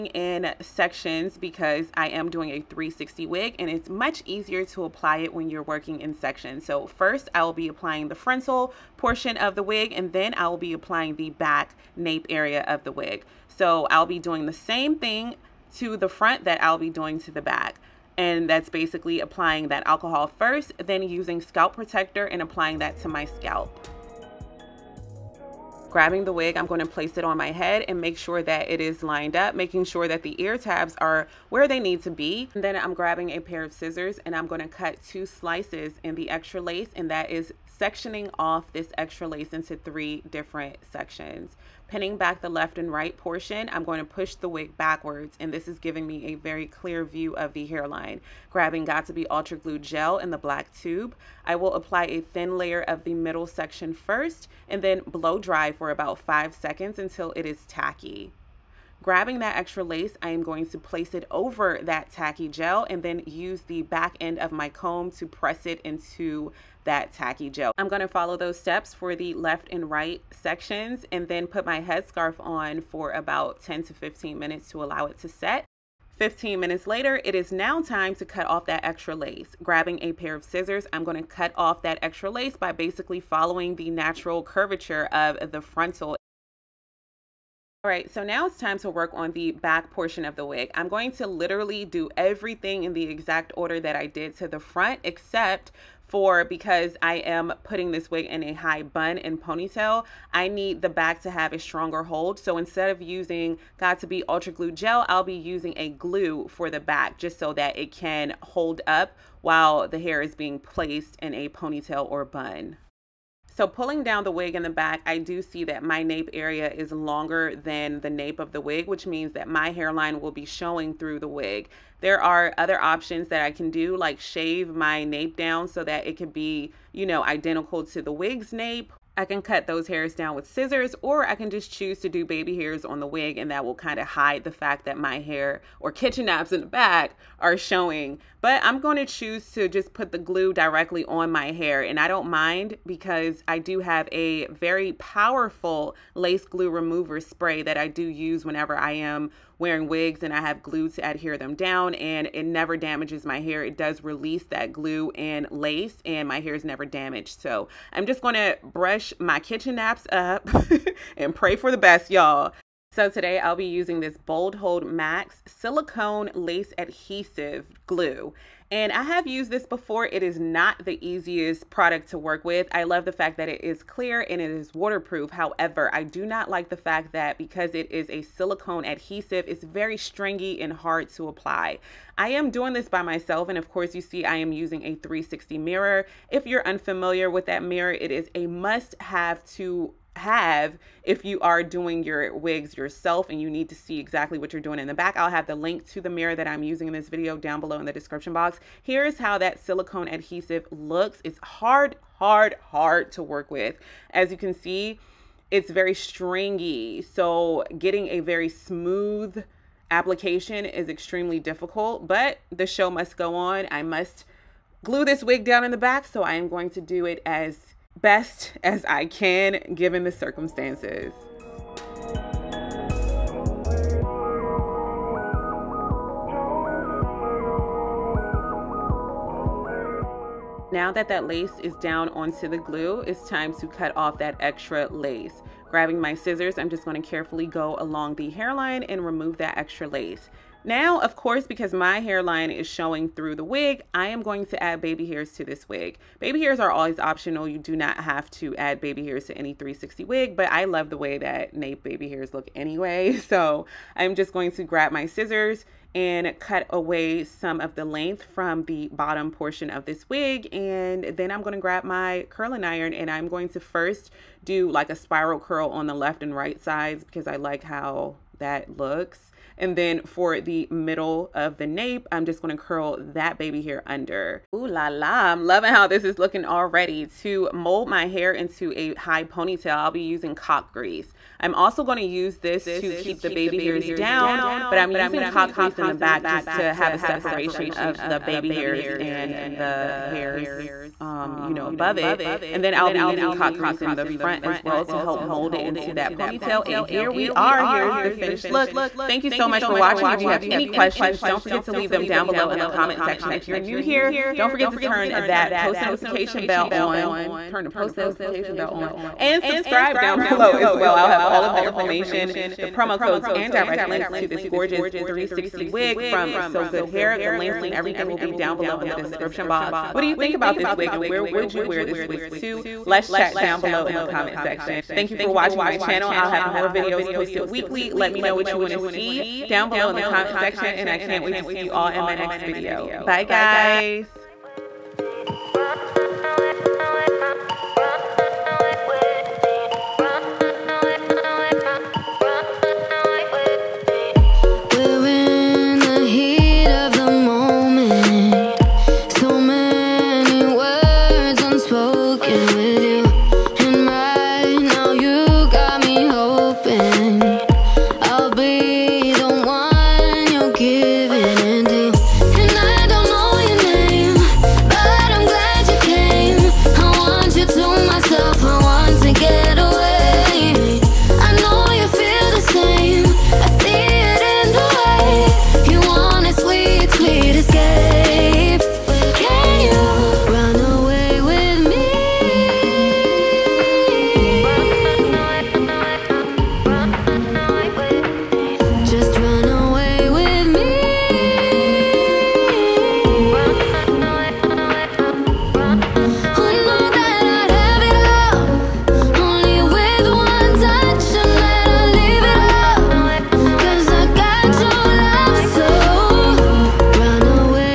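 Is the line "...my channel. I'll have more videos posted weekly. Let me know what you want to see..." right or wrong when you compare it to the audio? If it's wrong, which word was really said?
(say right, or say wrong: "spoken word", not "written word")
right.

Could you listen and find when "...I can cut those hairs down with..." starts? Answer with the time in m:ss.
2:09.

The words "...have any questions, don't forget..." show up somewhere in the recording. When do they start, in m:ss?
5:00.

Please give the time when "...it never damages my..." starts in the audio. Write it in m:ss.
2:32.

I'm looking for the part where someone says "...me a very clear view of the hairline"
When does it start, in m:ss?
0:46.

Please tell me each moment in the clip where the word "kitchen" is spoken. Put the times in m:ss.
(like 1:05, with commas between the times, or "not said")
2:15, 2:39.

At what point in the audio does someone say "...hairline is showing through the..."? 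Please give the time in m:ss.
4:02.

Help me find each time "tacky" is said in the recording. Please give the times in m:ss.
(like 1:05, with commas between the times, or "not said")
0:57, 1:02, 1:07.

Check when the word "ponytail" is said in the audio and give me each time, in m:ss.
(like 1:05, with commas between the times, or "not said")
1:39, 1:51, 4:39, 4:56.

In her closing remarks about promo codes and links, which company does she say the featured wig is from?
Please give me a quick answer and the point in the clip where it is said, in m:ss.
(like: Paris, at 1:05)
So Good Hair, at 5:16.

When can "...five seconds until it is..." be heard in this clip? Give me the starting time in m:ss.
0:56.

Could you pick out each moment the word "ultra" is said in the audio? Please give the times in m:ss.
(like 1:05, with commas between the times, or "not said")
0:49, 1:44.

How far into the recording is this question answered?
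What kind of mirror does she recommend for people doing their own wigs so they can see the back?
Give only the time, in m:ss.
3:04.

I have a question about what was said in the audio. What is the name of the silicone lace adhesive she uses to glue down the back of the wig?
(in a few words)
Bold Hold Max.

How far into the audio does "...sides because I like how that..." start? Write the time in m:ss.
4:26.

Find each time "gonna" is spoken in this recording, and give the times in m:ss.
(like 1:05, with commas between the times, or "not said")
1:07, 1:21, 3:56, 4:32, 4:41.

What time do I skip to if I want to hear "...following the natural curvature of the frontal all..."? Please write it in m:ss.
1:23.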